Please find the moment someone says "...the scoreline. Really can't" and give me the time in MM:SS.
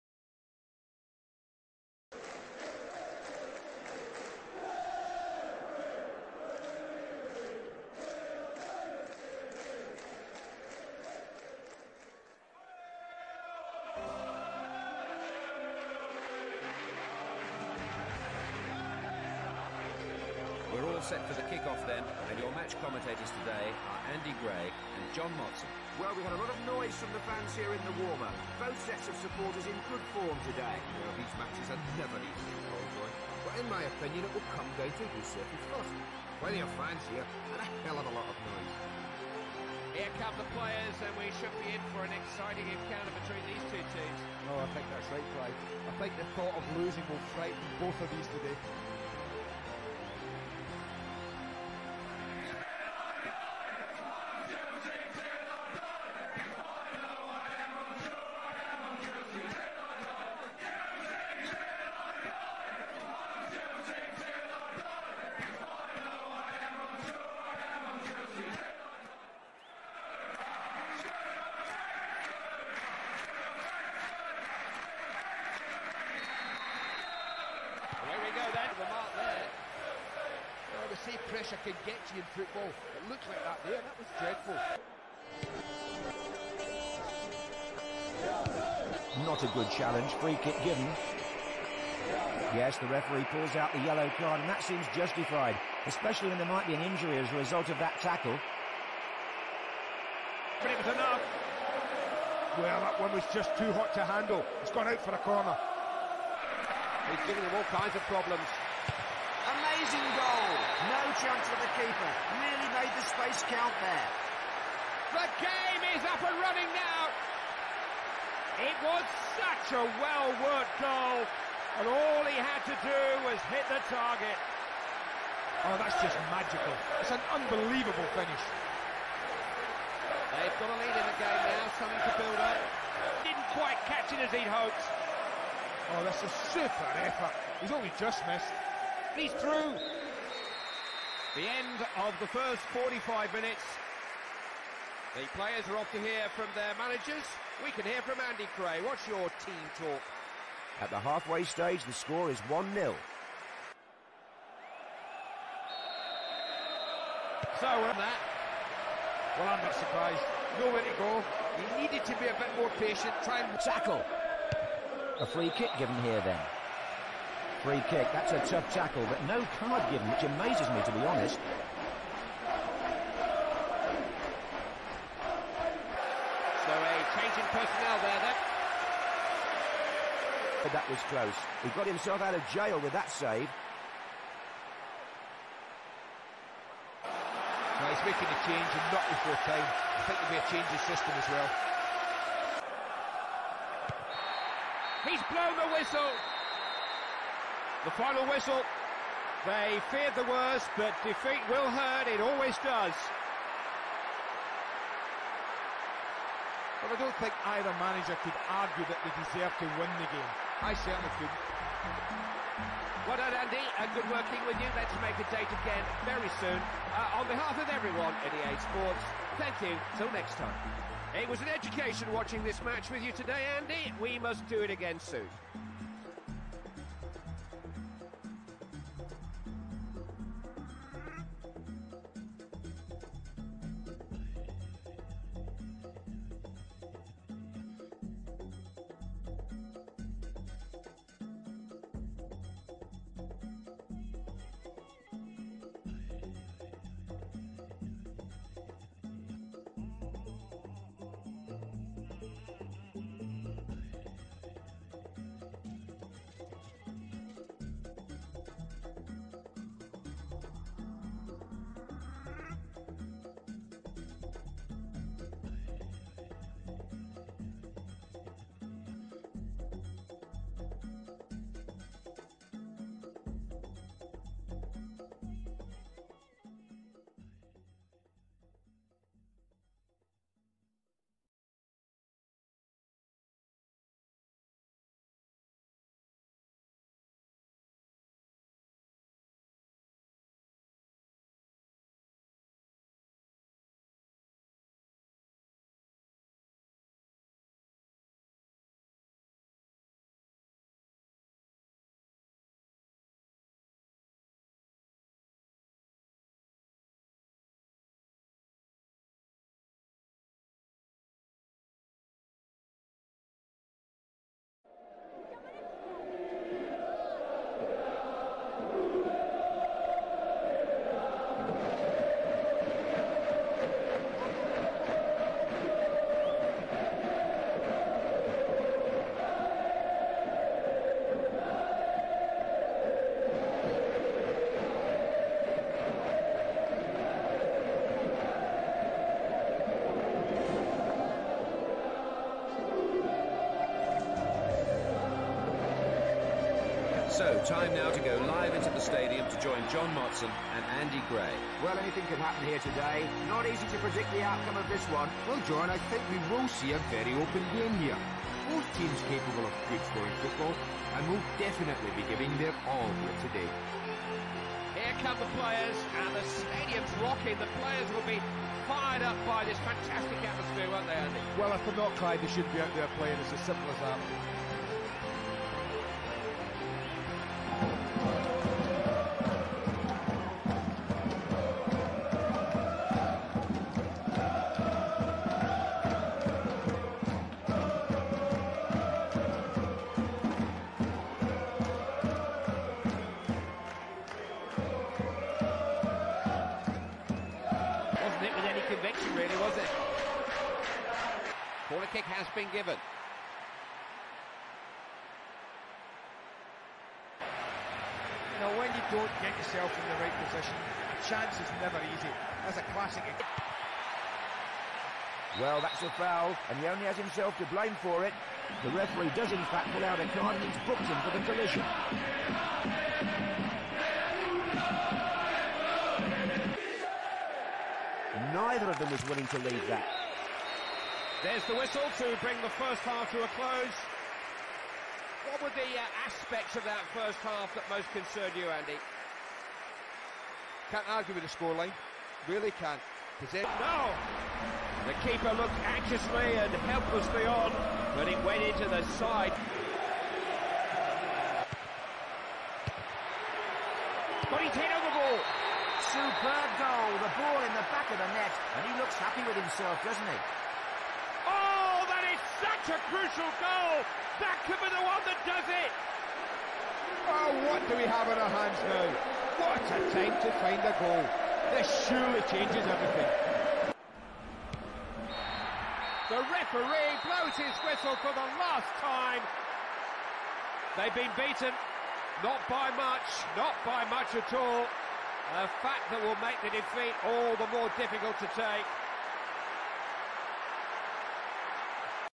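07:21.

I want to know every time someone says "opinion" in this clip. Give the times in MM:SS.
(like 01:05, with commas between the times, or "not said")
00:33.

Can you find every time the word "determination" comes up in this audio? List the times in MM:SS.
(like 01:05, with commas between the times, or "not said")
not said.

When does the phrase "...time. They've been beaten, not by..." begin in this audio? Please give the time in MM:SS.
07:58.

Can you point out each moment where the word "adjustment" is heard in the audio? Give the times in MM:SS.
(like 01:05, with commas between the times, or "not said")
not said.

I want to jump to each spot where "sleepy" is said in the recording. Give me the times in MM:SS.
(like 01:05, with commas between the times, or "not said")
not said.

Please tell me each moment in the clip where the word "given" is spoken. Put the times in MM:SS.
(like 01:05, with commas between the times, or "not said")
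01:30, 02:45, 02:49, 06:42.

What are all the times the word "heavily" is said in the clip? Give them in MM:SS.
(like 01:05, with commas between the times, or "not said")
not said.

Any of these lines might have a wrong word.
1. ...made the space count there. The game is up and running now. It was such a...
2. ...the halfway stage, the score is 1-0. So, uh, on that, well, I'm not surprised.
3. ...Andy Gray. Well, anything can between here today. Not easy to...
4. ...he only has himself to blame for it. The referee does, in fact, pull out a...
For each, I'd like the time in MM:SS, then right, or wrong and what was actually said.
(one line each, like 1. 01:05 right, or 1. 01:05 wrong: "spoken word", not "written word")
1. 01:52 right
2. 02:30 right
3. 05:50 wrong: "happen", not "between"
4. 06:56 right.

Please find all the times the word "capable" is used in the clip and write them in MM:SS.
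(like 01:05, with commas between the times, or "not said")
05:59.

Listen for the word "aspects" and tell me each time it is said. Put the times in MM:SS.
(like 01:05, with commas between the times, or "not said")
07:16.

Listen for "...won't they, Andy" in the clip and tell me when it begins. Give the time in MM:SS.
06:10.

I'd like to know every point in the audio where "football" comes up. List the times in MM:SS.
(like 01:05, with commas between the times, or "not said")
01:22, 06:00.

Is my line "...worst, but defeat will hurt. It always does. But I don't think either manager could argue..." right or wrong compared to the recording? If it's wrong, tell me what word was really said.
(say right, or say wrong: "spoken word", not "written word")
right.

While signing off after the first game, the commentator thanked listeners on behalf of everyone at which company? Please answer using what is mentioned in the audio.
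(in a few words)
EA Sports.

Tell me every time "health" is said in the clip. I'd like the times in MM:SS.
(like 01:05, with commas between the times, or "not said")
not said.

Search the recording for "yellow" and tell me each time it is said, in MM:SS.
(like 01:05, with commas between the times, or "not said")
01:33.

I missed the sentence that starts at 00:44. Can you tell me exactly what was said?
Oh, I think that's right, Clive.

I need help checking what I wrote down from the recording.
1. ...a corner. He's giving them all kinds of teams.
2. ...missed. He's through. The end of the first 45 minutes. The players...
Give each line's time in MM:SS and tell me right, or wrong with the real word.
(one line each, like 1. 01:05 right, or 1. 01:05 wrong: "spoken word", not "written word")
1. 01:45 wrong: "problems", not "teams"
2. 02:18 right.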